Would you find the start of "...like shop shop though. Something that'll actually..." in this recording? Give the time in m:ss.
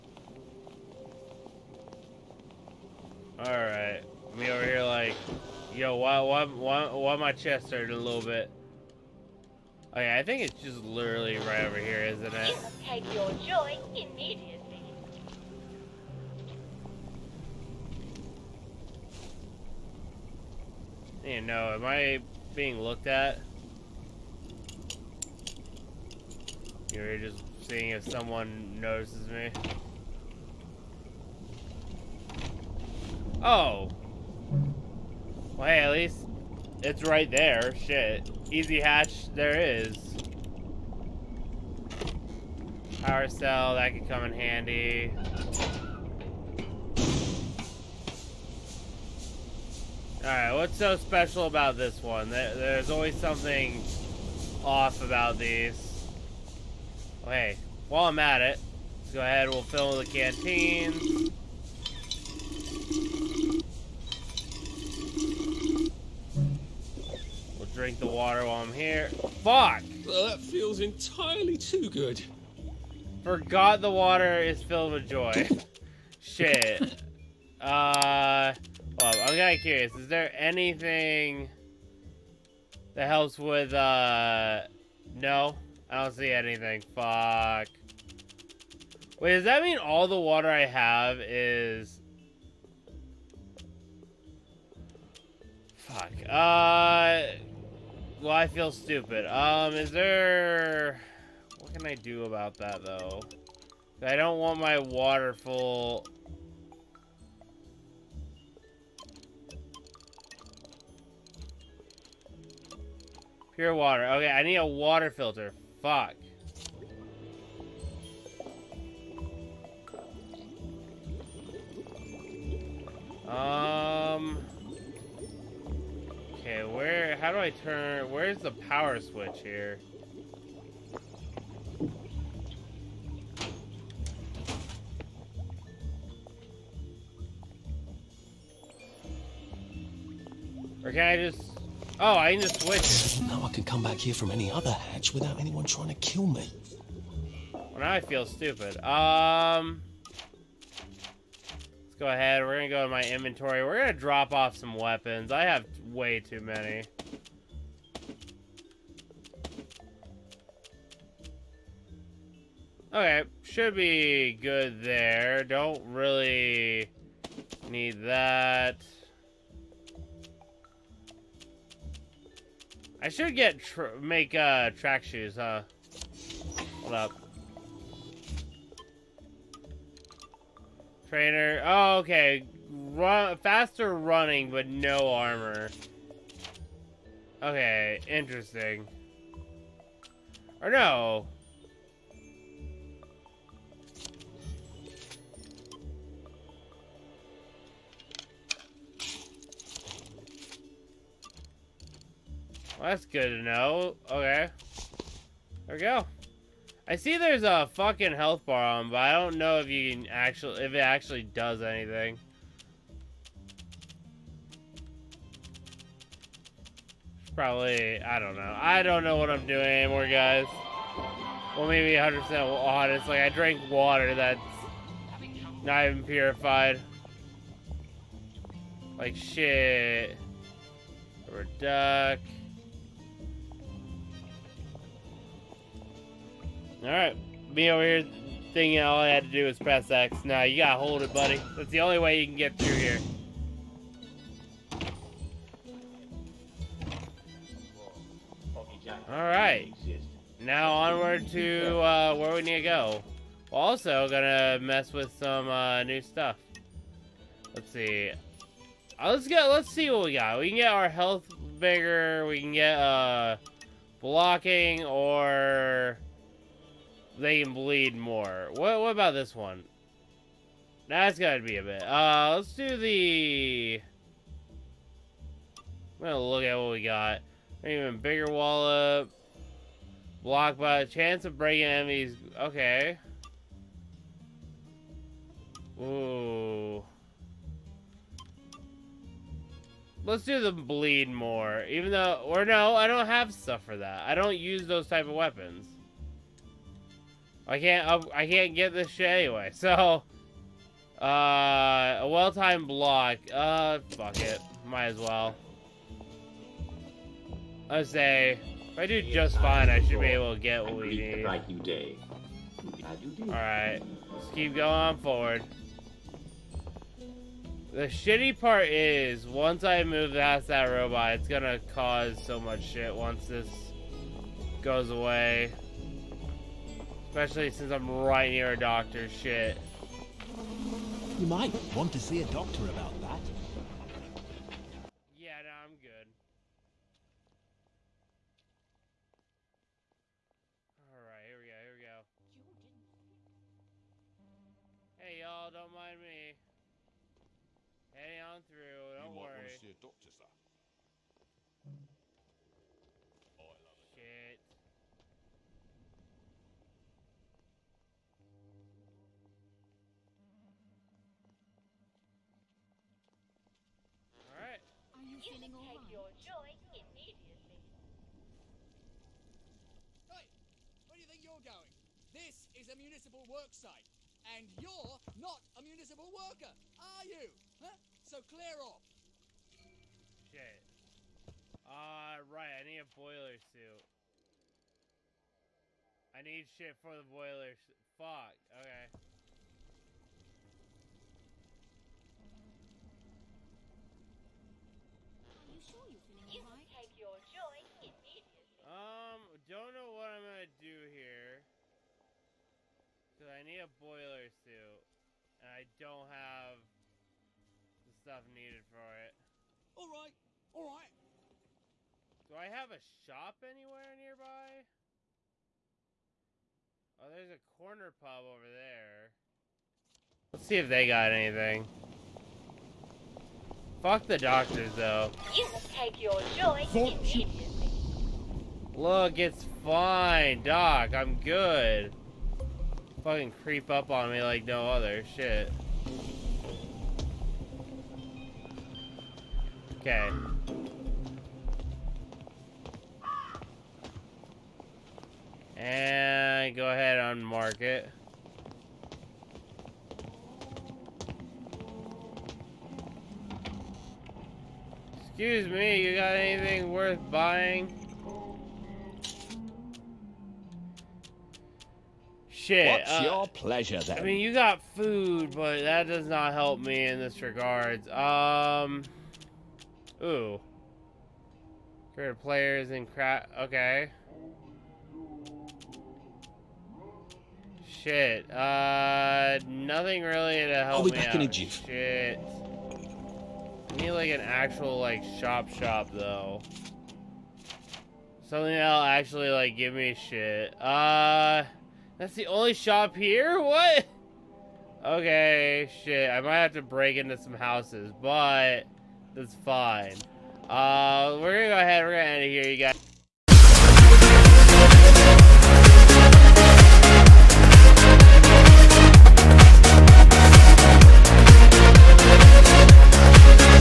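8:04.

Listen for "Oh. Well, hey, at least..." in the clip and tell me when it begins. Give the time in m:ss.
0:33.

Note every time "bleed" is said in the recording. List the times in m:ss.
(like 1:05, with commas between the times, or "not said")
4:27, 4:50.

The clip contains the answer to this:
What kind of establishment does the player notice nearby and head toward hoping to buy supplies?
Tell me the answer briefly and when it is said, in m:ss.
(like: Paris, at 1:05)
Corner pub, at 6:57.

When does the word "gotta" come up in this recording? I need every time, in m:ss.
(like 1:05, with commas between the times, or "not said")
4:00, 4:31.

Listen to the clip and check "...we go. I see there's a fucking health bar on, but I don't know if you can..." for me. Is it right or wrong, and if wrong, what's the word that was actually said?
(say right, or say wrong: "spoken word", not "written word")
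right.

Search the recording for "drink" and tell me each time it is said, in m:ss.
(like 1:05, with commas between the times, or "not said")
1:07.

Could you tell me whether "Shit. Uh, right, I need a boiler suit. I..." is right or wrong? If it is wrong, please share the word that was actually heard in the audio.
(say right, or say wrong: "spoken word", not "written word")
right.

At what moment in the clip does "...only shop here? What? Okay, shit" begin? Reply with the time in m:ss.
8:12.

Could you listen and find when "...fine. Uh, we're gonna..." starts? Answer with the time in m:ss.
8:19.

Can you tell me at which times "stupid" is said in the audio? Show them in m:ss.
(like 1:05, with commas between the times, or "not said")
1:38, 2:28.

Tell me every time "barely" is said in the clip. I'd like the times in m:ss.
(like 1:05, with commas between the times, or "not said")
not said.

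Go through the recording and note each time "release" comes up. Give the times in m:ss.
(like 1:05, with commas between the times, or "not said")
not said.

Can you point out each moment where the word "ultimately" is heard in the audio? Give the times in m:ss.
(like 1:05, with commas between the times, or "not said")
not said.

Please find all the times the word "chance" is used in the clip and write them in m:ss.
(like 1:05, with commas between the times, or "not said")
4:40.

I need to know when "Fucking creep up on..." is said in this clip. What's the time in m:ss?
7:13.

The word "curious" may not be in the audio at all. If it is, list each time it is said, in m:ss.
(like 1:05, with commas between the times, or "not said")
1:19.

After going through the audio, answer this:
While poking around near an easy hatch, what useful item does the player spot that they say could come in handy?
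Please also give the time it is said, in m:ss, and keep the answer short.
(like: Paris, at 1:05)
Power cell, at 0:43.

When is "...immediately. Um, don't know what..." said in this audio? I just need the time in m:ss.
6:37.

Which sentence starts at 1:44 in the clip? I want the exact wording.
I don't want my water full...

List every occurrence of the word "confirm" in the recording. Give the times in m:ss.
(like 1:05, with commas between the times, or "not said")
not said.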